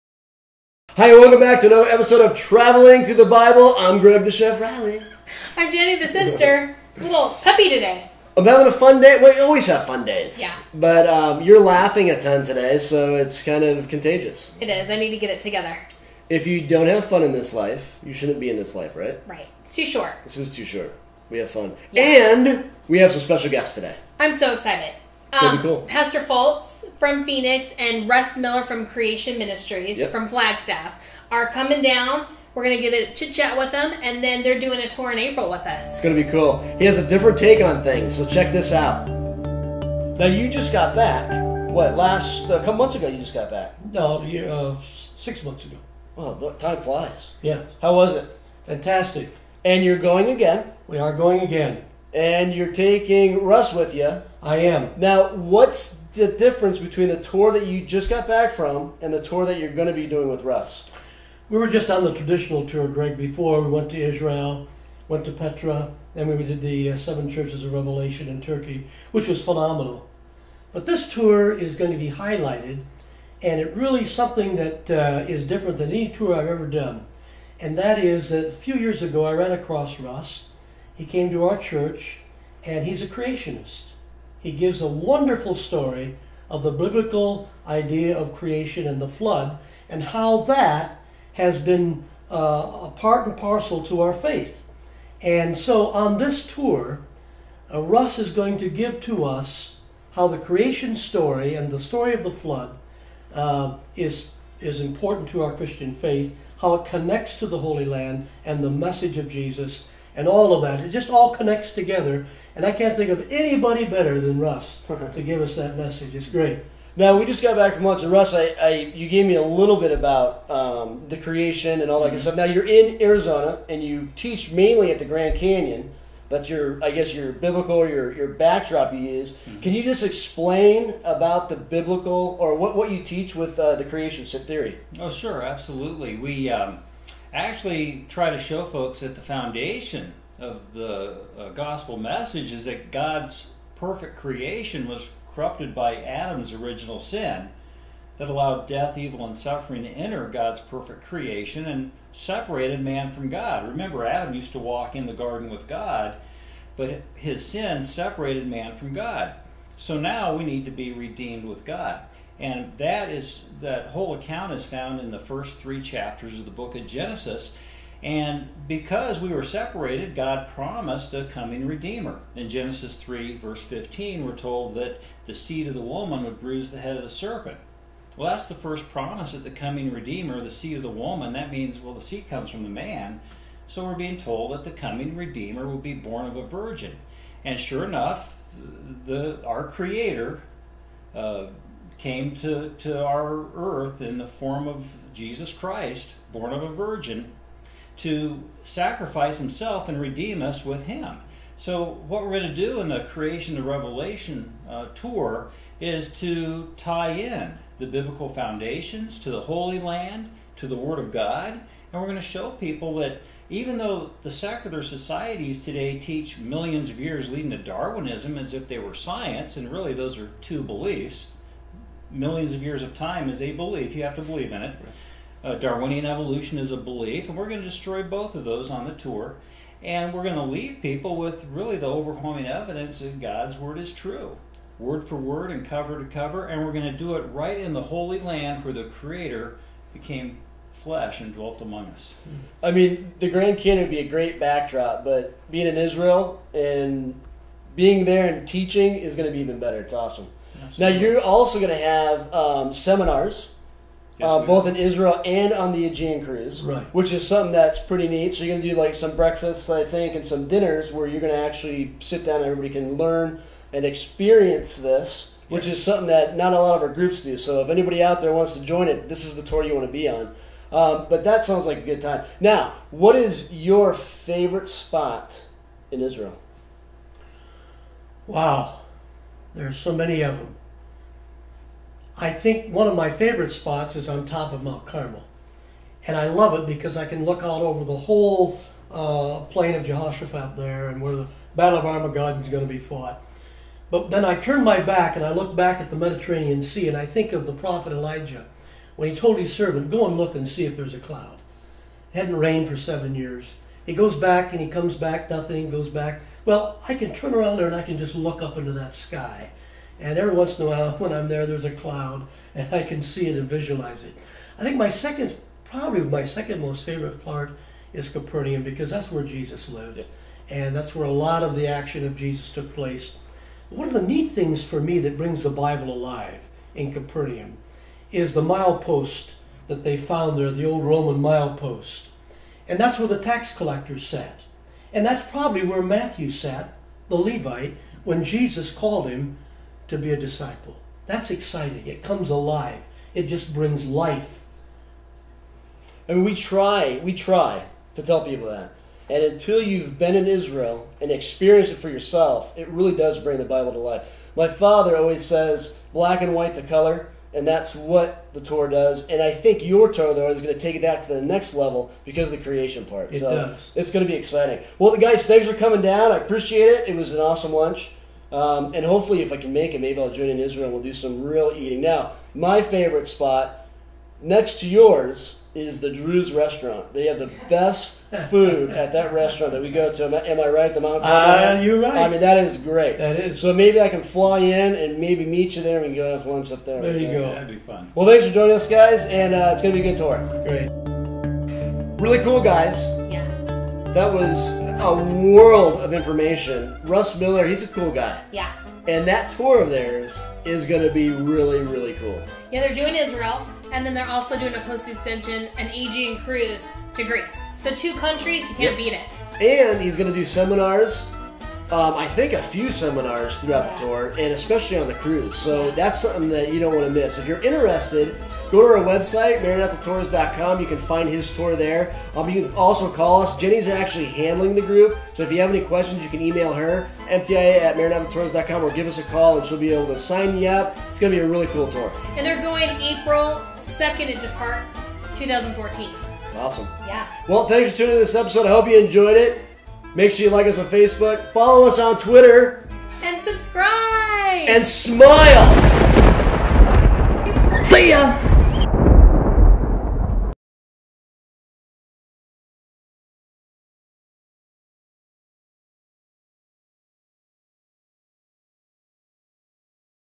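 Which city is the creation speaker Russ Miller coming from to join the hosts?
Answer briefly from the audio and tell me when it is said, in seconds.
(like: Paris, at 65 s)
Flagstaff, at 30 s.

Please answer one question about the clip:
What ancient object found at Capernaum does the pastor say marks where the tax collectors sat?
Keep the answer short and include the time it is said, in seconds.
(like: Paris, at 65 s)
Roman milepost, at 330 s.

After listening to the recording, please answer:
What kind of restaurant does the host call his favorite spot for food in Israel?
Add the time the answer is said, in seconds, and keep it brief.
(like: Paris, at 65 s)
Druze restaurant, at 375 s.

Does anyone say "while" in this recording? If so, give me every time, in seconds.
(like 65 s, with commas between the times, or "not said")
310 s.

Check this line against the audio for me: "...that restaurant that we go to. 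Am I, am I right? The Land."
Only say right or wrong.
wrong.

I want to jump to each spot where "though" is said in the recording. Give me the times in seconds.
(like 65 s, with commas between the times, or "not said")
213 s, 360 s.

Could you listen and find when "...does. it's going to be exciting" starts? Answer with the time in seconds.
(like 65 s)
363 s.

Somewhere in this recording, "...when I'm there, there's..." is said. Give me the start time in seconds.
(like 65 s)
310 s.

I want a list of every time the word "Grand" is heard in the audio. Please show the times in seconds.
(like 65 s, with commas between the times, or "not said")
125 s, 243 s.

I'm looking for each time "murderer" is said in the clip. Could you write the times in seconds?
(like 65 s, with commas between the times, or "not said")
not said.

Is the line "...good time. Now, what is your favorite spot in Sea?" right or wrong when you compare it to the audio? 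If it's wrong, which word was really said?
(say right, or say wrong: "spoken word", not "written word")
wrong: "Israel", not "Sea".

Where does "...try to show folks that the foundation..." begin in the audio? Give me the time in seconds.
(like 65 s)
138 s.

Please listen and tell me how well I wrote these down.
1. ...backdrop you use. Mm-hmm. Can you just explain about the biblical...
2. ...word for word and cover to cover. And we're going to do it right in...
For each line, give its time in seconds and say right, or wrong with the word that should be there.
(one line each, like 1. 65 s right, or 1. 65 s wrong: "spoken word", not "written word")
1. 128 s right
2. 234 s right.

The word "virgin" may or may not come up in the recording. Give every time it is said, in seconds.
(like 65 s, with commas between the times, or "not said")
186 s, 196 s.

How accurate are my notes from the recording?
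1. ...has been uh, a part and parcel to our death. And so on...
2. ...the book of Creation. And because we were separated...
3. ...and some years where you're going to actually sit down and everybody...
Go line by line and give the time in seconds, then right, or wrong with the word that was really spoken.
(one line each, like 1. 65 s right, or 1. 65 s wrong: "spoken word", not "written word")
1. 91 s wrong: "faith", not "death"
2. 166 s wrong: "Genesis", not "Creation"
3. 260 s wrong: "dinners", not "years".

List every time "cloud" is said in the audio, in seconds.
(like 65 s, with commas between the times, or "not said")
300 s, 311 s.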